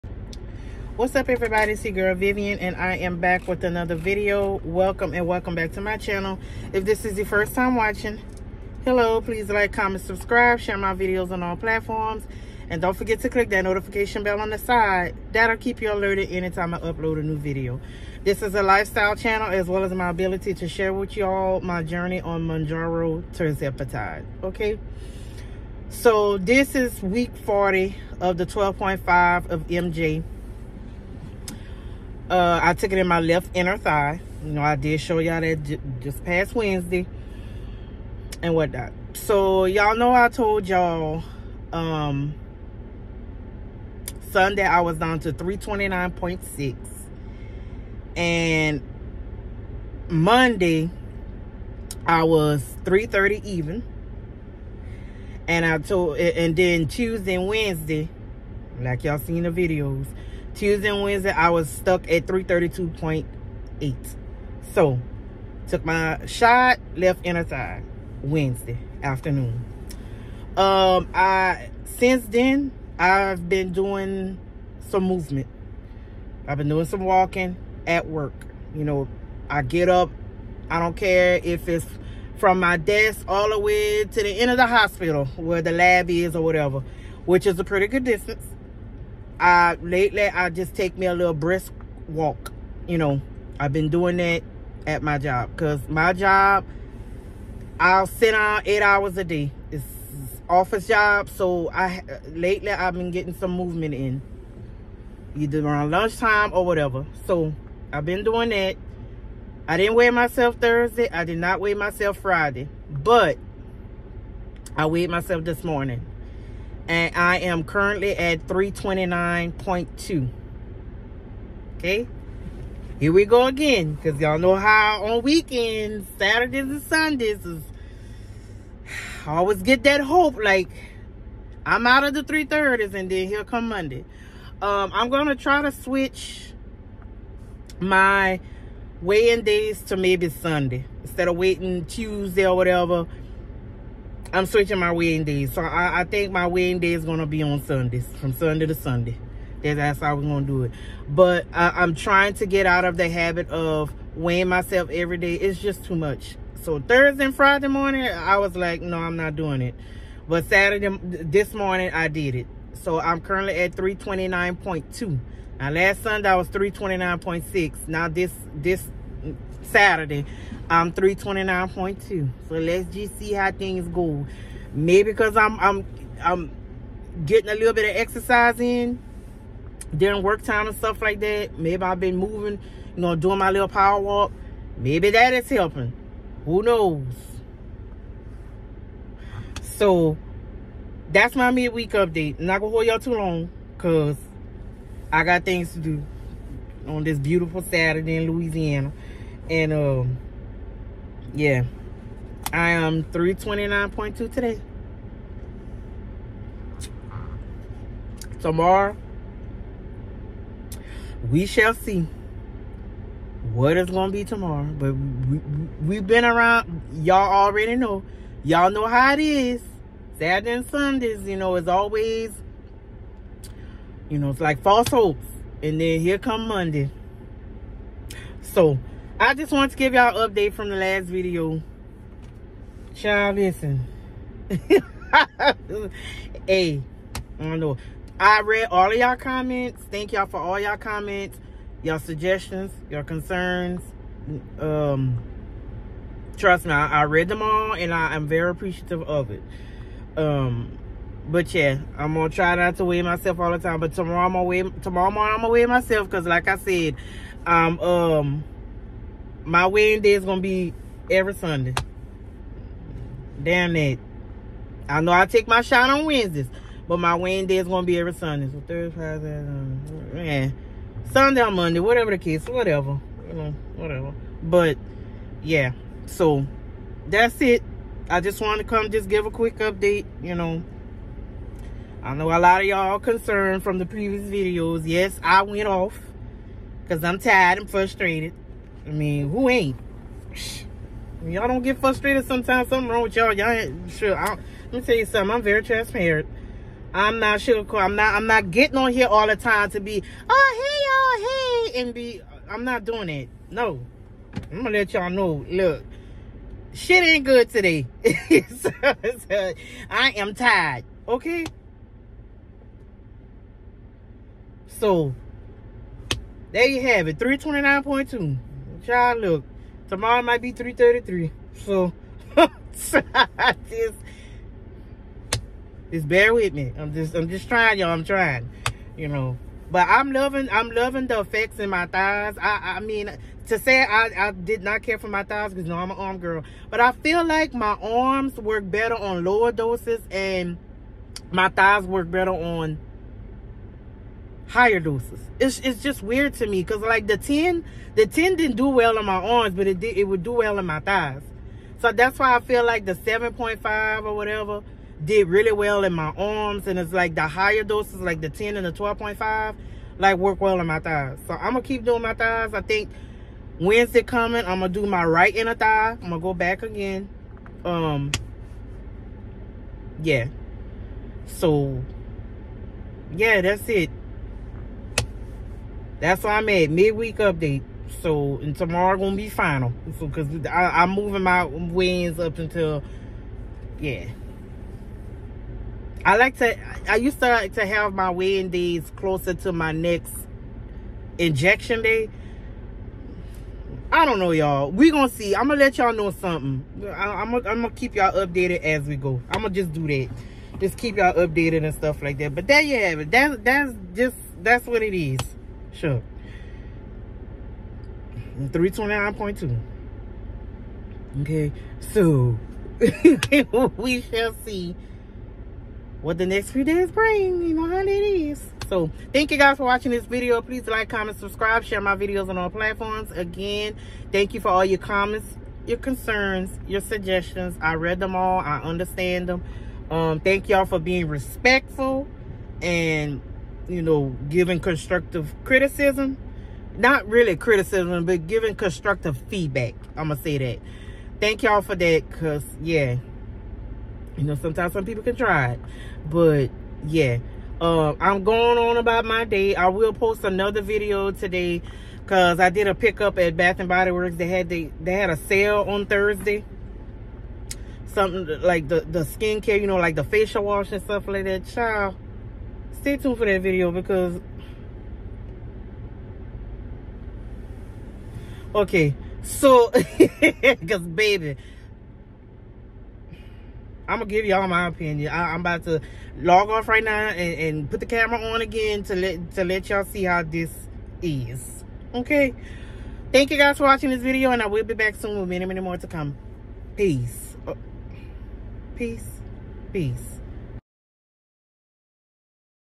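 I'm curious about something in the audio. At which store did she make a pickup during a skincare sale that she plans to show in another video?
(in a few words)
Bath and Body Works.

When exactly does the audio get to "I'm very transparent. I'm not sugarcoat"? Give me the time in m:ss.
4:55.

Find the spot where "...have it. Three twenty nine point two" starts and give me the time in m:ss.
5:16.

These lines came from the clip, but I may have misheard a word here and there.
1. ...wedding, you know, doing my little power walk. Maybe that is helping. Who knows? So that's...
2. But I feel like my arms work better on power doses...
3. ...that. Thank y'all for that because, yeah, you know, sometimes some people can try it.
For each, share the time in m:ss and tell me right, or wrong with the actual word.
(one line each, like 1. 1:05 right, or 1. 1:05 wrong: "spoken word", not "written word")
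1. 3:02 wrong: "moving", not "wedding"
2. 5:36 wrong: "lower", not "power"
3. 7:20 right.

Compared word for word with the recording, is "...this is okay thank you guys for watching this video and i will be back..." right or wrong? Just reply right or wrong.
right.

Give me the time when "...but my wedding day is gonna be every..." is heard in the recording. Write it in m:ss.
4:26.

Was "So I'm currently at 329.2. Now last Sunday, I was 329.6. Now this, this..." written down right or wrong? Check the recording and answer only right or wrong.
right.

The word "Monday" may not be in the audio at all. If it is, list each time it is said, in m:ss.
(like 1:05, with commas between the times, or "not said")
0:50, 2:13, 3:46, 4:31.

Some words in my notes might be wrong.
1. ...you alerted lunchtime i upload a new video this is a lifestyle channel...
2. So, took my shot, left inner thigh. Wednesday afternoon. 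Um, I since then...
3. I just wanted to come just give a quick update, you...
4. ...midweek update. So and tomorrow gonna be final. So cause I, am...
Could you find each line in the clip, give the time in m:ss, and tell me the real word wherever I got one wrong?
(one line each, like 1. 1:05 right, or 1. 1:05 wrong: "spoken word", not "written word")
1. 0:15 wrong: "anytime", not "lunchtime"
2. 1:04 right
3. 4:38 right
4. 6:16 right.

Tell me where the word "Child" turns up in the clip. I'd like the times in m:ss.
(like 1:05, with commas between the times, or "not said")
3:52, 7:41.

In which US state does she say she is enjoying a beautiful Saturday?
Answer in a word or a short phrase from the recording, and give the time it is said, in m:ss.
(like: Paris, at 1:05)
Louisiana, at 3:18.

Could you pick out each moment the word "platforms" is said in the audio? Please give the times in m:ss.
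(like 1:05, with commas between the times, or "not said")
0:11, 7:02.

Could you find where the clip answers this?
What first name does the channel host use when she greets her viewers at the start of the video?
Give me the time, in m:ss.
0:02.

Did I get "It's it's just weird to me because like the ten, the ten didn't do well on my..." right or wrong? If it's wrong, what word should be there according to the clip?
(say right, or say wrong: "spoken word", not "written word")
right.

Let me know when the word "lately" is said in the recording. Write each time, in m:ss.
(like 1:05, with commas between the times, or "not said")
1:29, 1:42.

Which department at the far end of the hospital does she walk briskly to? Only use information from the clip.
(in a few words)
The lab.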